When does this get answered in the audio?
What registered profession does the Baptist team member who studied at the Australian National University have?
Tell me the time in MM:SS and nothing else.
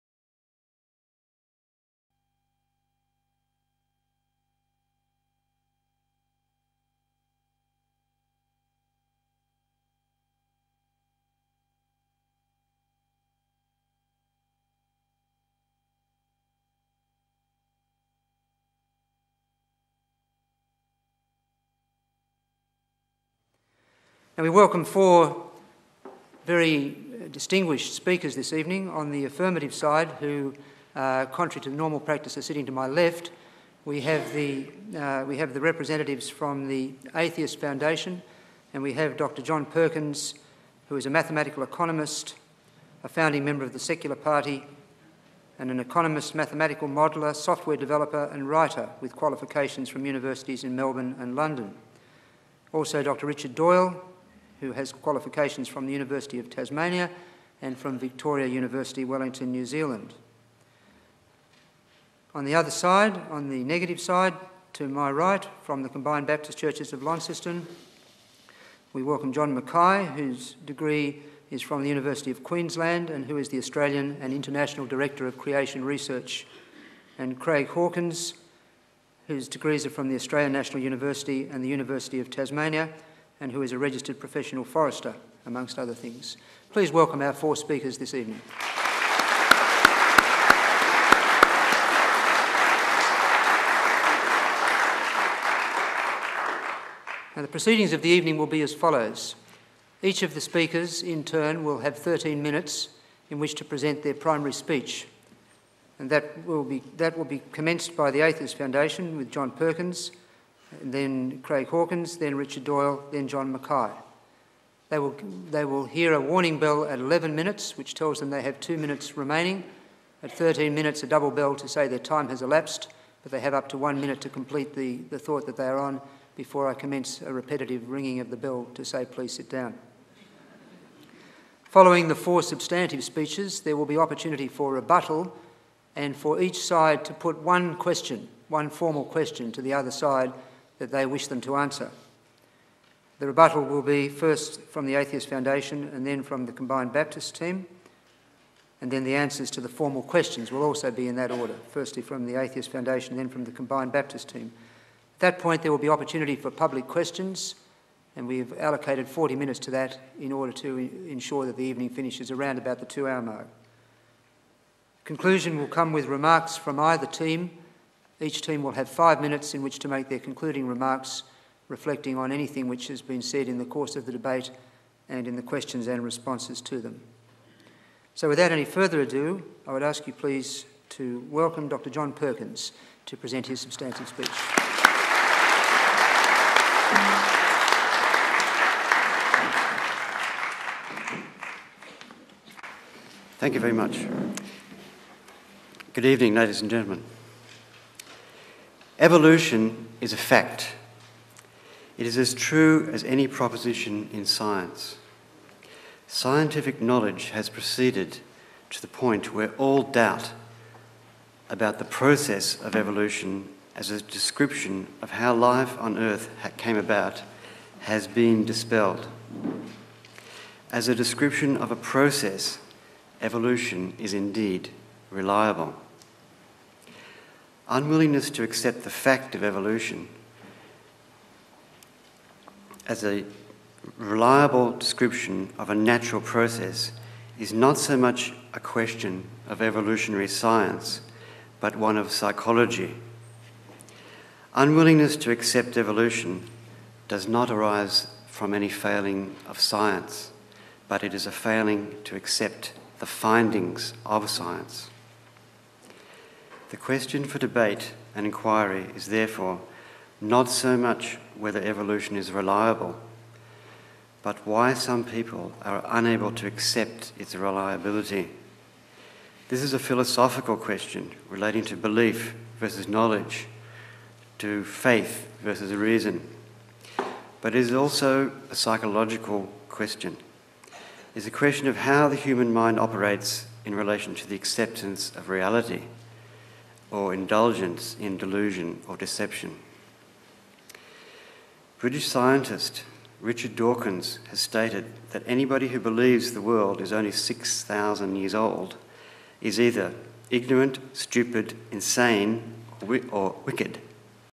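01:24.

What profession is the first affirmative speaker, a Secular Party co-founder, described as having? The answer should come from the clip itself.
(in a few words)
Mathematical economist.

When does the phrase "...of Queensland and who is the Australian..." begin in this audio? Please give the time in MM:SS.
01:12.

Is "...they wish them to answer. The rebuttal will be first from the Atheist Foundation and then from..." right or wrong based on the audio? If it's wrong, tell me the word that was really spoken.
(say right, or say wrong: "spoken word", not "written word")
right.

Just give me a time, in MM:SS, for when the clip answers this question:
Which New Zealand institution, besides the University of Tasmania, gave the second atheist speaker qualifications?
00:57.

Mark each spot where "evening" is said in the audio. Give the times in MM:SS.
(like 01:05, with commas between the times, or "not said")
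00:28, 01:28, 01:38, 02:41, 03:16.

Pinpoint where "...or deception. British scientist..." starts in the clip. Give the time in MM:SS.
04:48.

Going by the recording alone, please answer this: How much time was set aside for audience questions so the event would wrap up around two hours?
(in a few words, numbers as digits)
40 minutes.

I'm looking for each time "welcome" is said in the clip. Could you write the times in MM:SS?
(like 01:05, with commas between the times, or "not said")
00:24, 01:09, 01:26, 03:01.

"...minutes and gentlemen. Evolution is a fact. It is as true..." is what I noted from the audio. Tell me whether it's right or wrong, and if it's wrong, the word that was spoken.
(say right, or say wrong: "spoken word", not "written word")
wrong: "ladies", not "minutes".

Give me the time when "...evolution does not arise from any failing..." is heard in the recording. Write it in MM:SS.
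04:05.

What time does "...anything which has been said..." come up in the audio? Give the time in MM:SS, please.
02:52.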